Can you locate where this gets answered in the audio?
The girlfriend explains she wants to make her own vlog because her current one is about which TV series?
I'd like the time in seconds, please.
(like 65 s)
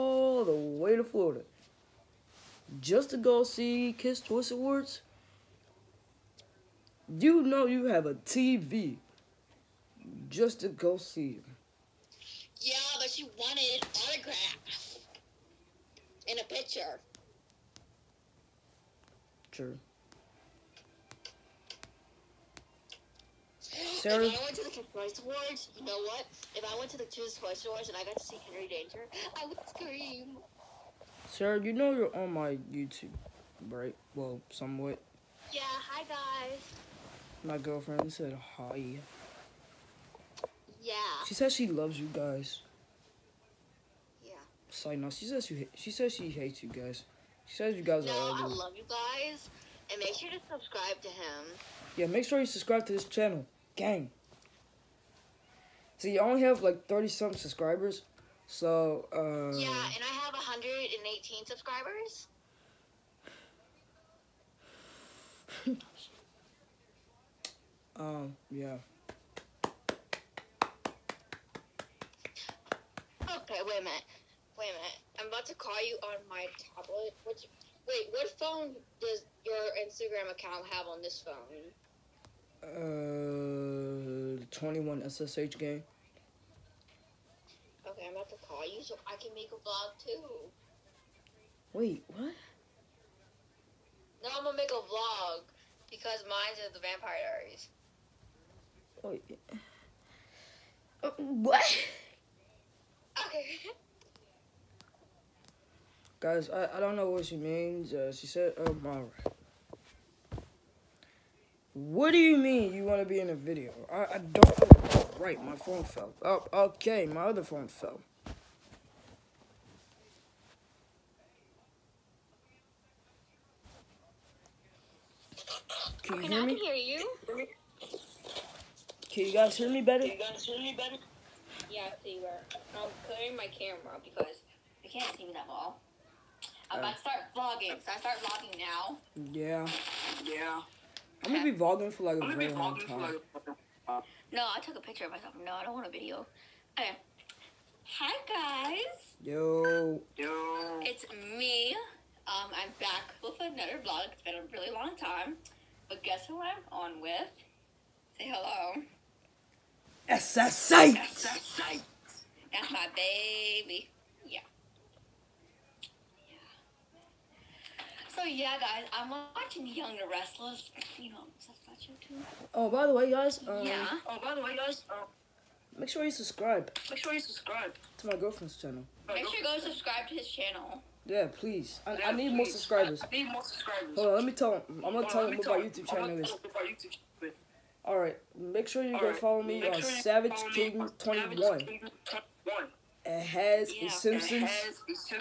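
96 s.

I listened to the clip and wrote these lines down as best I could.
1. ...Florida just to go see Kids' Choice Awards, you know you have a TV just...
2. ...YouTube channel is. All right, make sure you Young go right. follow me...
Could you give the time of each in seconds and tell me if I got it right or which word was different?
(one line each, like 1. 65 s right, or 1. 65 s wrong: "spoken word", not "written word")
1. 1 s right
2. 185 s wrong: "All", not "Young".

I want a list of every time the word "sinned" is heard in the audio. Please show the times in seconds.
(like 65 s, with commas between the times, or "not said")
not said.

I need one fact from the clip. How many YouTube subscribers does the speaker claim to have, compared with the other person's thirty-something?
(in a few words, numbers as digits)
118.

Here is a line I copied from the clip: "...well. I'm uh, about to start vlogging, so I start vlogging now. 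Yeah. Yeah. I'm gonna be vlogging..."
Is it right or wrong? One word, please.
right.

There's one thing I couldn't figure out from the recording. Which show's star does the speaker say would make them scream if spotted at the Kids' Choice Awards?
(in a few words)
Henry Danger.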